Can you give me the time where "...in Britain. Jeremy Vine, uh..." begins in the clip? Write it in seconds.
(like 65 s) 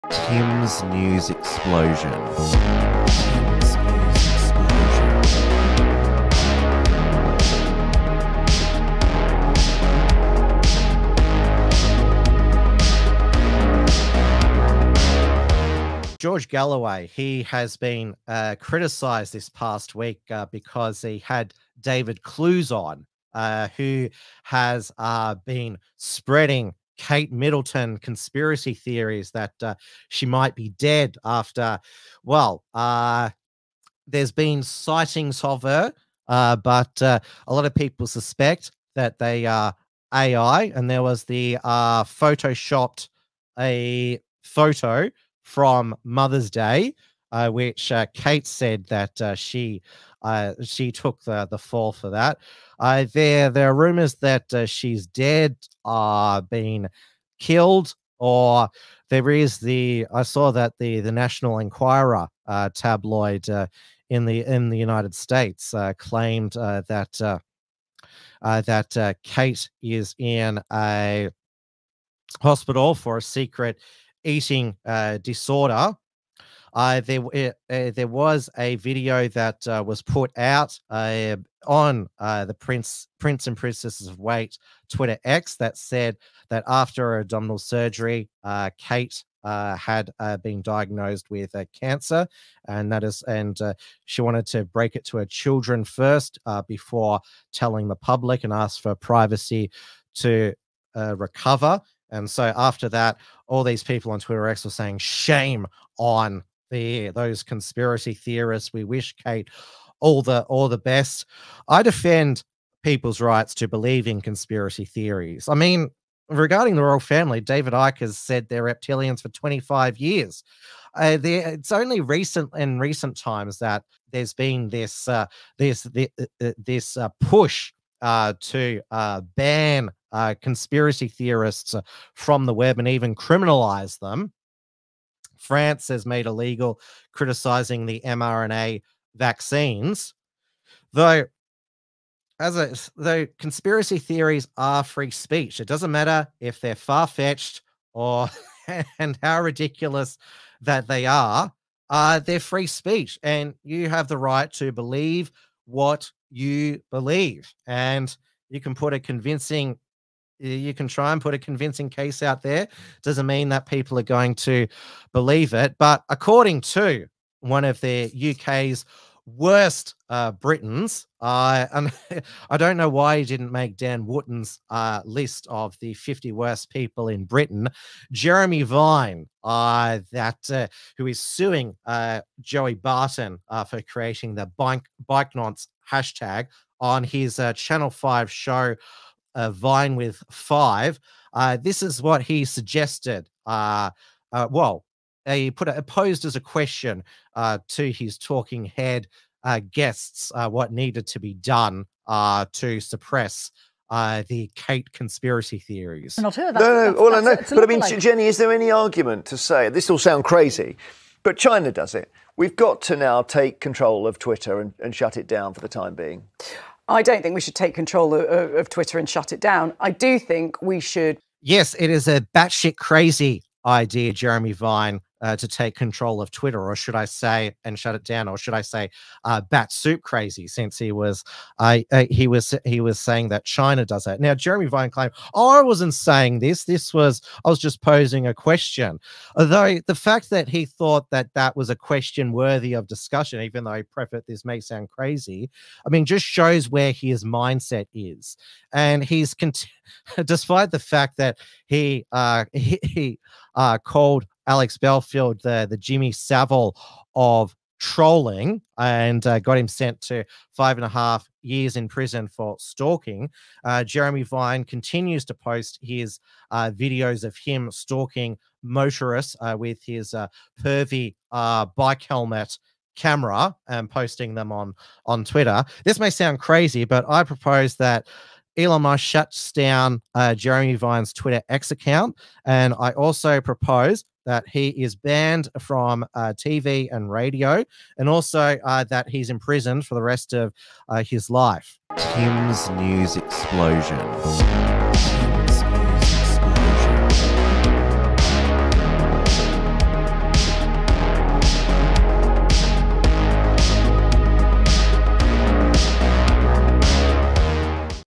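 177 s.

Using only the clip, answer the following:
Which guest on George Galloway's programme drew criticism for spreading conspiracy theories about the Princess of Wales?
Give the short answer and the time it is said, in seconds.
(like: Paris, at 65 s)
David Clews, at 21 s.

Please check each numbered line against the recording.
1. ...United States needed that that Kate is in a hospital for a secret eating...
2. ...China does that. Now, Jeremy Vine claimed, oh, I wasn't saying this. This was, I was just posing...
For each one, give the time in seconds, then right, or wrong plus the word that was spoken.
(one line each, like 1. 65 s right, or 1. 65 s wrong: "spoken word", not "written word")
1. 64 s wrong: "claimed", not "needed"
2. 233 s right.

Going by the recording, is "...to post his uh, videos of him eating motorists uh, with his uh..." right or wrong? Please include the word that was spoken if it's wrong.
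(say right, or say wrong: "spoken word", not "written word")
wrong: "stalking", not "eating".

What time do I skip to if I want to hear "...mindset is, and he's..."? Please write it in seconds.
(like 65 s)
247 s.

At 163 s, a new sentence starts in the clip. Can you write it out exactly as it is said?
Doesn't mean that people are going to believe it.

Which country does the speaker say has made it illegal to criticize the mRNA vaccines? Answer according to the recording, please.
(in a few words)
France.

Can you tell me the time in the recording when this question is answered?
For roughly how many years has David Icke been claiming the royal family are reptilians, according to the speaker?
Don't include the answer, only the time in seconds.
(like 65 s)
119 s.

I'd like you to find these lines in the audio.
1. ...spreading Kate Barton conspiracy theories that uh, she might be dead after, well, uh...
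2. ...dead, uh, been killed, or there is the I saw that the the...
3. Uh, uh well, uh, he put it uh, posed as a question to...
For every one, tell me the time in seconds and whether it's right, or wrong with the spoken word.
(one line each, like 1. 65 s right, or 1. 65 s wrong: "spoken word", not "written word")
1. 25 s wrong: "Middleton", not "Barton"
2. 55 s right
3. 193 s right.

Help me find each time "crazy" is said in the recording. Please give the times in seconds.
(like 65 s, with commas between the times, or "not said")
210 s, 222 s, 230 s, 244 s, 276 s.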